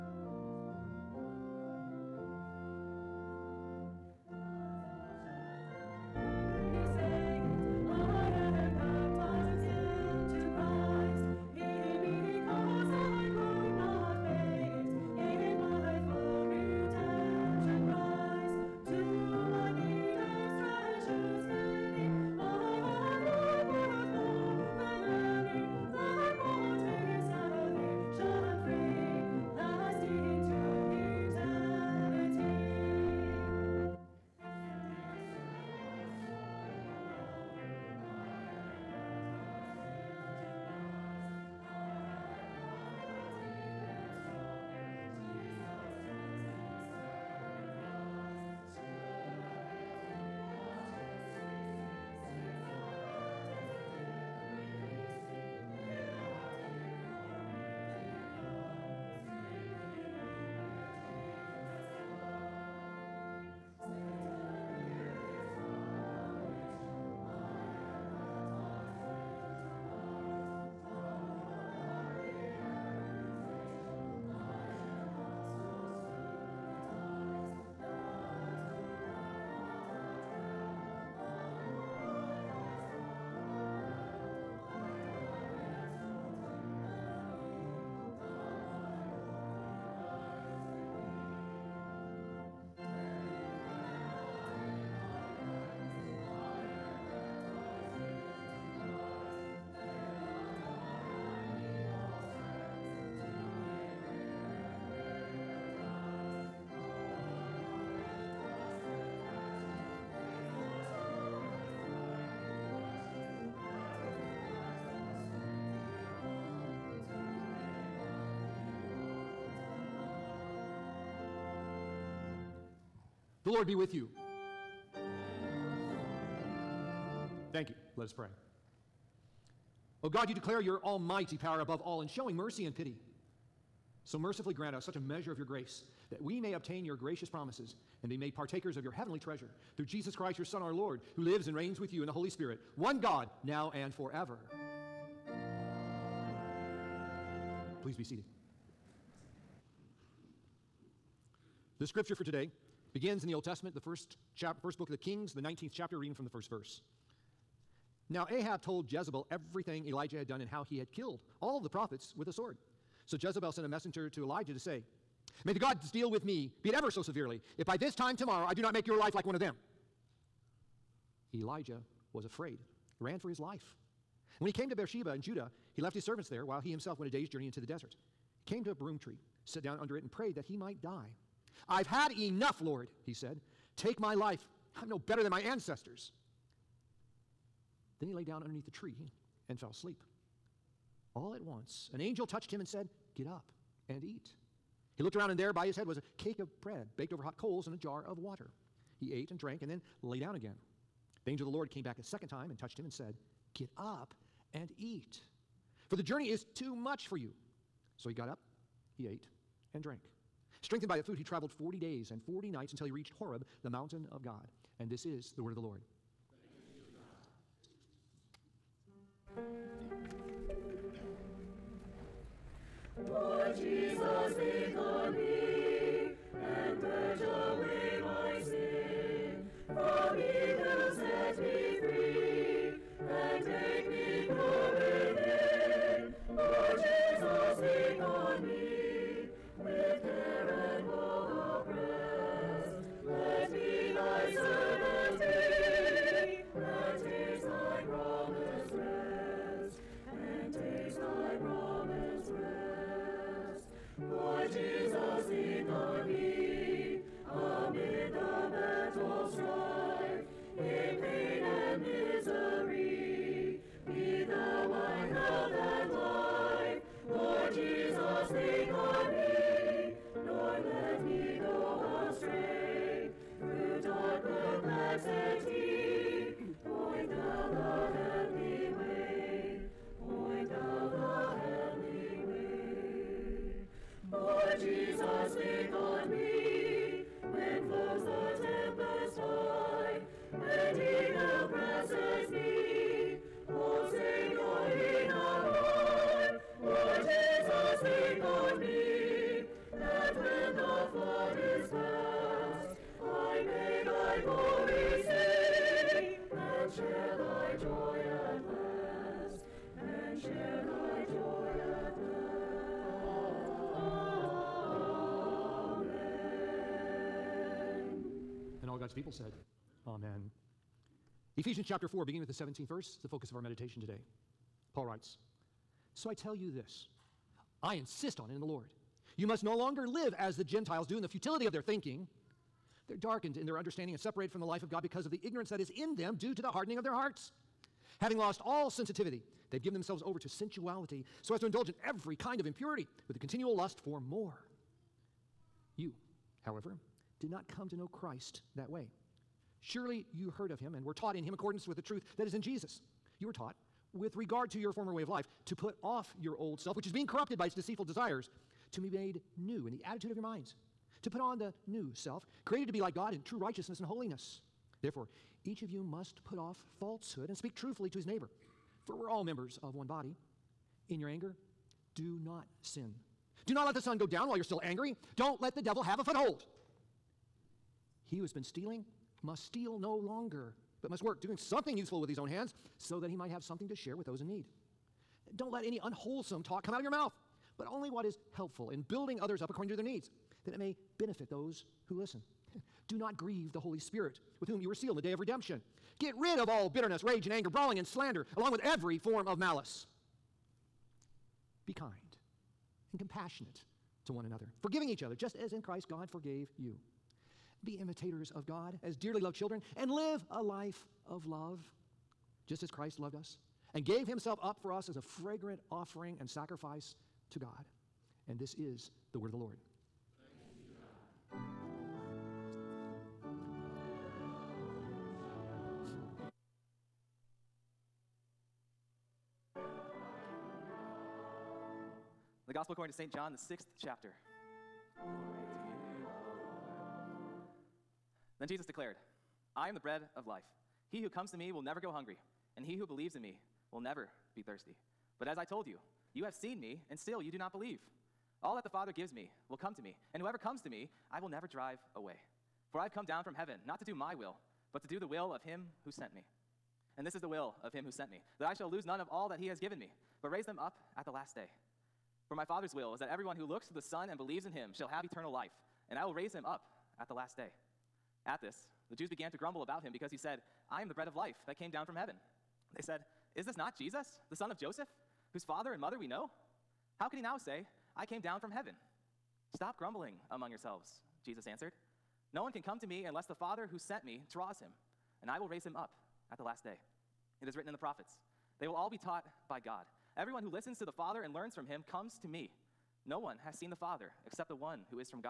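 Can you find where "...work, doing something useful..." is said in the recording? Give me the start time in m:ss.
6:21.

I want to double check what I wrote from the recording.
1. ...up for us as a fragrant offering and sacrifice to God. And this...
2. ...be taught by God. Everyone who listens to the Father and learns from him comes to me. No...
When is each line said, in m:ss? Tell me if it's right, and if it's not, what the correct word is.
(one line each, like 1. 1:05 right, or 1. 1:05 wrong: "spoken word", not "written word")
1. 6:54 right
2. 8:08 right.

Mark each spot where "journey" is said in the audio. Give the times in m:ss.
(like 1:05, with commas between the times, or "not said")
2:57, 3:26.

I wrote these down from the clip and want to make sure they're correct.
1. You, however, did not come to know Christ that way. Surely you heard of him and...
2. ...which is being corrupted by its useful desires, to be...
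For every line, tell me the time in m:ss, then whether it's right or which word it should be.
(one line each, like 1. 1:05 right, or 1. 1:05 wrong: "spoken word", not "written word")
1. 5:45 right
2. 5:56 wrong: "deceitful", not "useful".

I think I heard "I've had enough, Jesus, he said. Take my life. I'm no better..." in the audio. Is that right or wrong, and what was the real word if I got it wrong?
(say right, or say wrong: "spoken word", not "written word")
wrong: "Lord", not "Jesus".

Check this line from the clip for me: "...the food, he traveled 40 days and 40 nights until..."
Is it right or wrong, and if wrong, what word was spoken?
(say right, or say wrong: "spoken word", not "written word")
right.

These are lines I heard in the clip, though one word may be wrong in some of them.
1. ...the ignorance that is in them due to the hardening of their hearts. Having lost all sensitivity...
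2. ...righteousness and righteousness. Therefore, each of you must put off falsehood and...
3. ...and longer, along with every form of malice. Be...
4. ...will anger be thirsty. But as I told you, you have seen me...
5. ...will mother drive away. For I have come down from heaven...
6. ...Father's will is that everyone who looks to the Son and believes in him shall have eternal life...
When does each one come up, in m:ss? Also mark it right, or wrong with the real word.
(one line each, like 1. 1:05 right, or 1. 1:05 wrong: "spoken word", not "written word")
1. 5:35 right
2. 6:03 wrong: "holiness", not "righteousness"
3. 6:37 wrong: "slander", not "longer"
4. 7:23 wrong: "never", not "anger"
5. 7:31 wrong: "never", not "mother"
6. 7:42 right.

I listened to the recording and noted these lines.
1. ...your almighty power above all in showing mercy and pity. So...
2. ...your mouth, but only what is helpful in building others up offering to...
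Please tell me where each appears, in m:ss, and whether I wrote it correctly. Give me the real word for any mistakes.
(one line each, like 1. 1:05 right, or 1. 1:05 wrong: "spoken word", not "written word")
1. 2:10 right
2. 6:26 wrong: "according", not "offering".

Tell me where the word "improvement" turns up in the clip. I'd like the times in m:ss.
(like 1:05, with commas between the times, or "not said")
not said.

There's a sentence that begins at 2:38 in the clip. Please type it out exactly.
Now, Ahab told Jezebel everything Elijah had done and how he had killed all the prophets with a sword.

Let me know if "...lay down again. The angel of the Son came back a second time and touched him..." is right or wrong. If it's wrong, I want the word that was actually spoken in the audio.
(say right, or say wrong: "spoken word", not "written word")
wrong: "Lord", not "Son".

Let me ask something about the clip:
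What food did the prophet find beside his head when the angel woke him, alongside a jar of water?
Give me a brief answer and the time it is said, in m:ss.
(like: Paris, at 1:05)
a cake of bread, at 3:15.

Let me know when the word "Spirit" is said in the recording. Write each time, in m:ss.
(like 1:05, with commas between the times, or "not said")
2:22, 6:33.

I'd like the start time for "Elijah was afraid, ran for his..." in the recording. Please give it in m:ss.
2:51.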